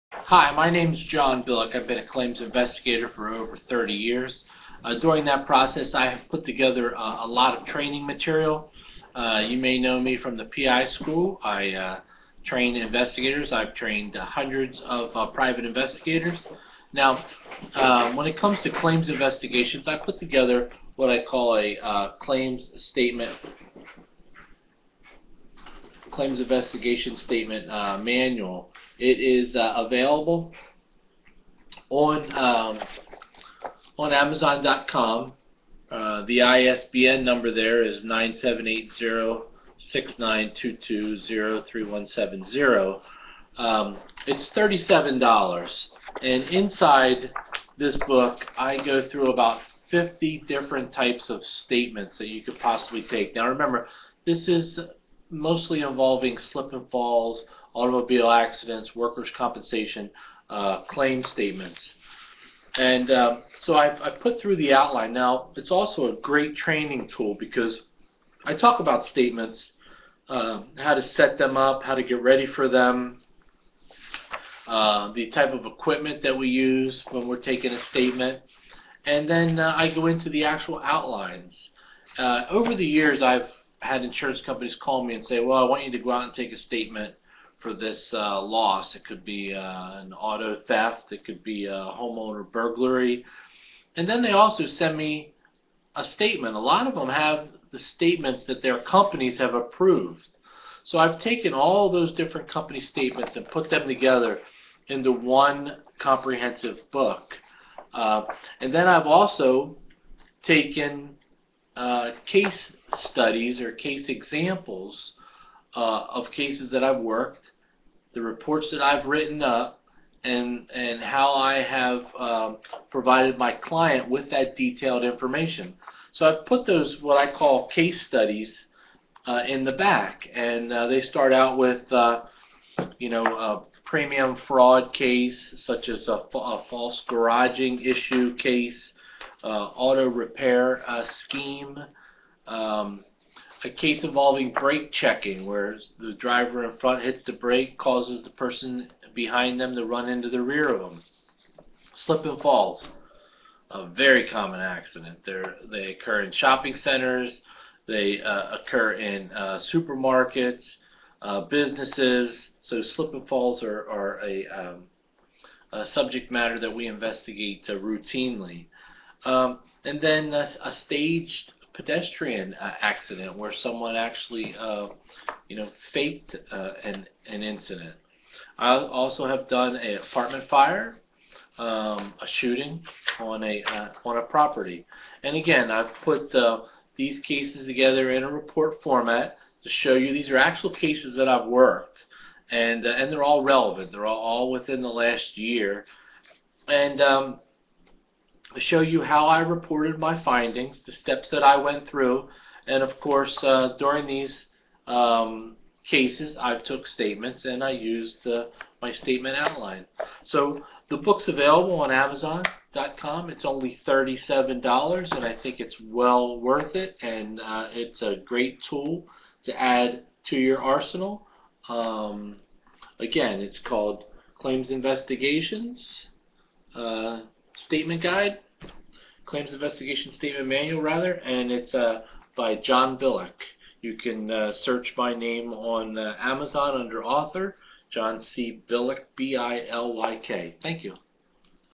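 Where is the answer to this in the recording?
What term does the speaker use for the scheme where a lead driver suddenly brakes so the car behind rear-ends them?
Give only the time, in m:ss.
2:24.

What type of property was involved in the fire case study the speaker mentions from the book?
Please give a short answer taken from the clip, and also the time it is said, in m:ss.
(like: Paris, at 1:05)
apartment, at 2:59.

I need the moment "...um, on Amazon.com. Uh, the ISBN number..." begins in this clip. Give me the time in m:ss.
0:32.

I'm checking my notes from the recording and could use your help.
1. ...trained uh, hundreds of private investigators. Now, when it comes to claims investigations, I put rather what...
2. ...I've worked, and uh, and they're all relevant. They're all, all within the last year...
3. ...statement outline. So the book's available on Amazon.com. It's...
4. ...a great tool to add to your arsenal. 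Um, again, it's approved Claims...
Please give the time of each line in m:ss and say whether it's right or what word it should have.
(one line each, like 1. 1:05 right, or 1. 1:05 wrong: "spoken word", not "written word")
1. 0:13 wrong: "together", not "rather"
2. 3:11 right
3. 3:28 right
4. 3:38 wrong: "called", not "approved".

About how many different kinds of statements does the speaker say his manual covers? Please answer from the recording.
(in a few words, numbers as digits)
50.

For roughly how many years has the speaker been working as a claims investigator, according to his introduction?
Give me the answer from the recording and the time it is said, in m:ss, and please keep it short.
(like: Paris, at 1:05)
over 30 years, at 0:03.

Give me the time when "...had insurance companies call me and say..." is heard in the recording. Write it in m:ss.
1:23.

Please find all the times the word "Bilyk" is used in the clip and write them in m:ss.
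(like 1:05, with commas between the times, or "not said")
0:01, 3:52, 3:58.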